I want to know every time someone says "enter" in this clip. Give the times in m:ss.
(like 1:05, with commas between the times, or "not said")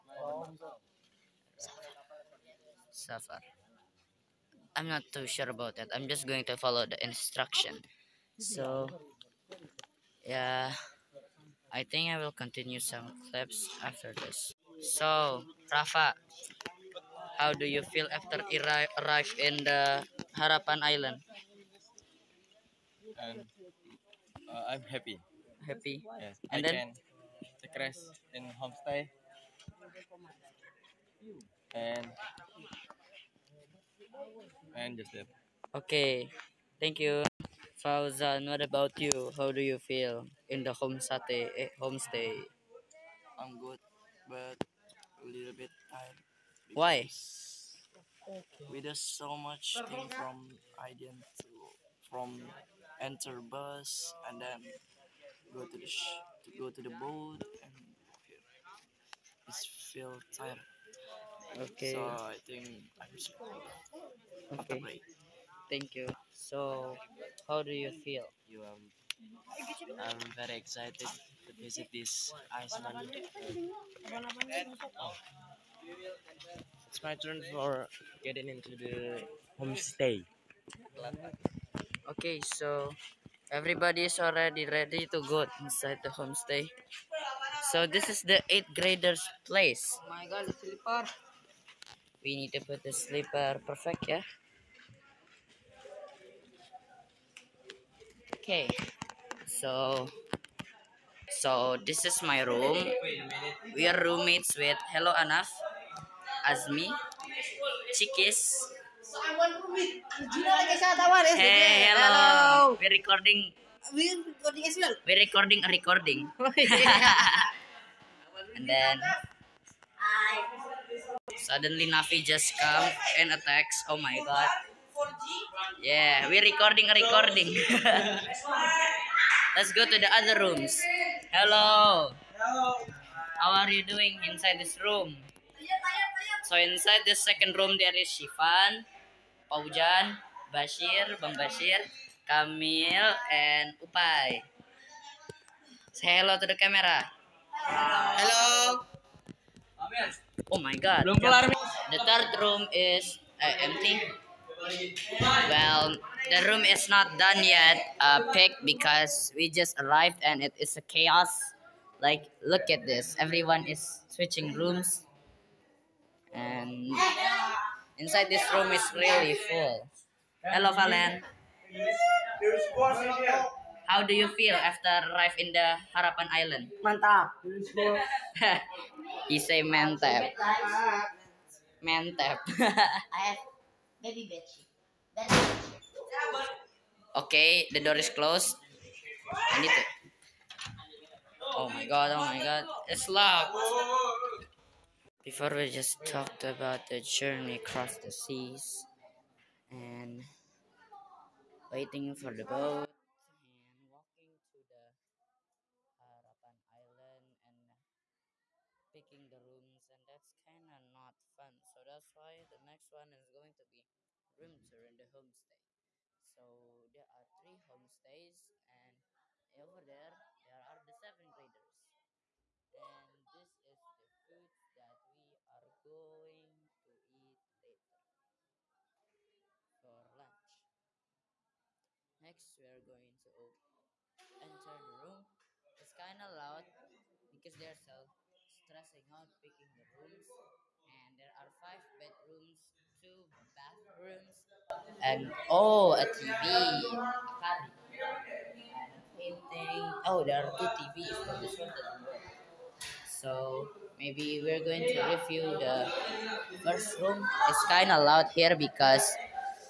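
0:53, 3:54.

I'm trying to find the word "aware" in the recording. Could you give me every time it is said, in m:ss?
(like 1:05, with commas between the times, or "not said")
not said.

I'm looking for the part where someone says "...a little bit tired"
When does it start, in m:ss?
0:45.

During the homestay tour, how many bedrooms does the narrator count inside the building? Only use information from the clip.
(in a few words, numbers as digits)
5.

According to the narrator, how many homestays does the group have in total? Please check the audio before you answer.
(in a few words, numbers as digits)
3.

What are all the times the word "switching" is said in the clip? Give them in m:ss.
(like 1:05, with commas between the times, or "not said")
2:44.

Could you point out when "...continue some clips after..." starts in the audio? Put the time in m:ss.
0:12.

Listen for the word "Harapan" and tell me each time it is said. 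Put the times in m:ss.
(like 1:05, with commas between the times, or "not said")
0:20, 2:55, 3:26.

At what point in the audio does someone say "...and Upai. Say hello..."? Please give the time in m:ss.
2:23.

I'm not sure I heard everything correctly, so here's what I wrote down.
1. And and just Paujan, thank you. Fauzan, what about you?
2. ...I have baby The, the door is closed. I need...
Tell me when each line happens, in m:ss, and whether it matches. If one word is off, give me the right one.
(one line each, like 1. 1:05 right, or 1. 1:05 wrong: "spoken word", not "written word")
1. 0:31 wrong: "Okay", not "Paujan"
2. 3:03 wrong: "Okay", not "The".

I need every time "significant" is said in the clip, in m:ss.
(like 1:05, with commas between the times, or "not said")
not said.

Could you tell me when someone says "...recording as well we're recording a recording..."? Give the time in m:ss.
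1:54.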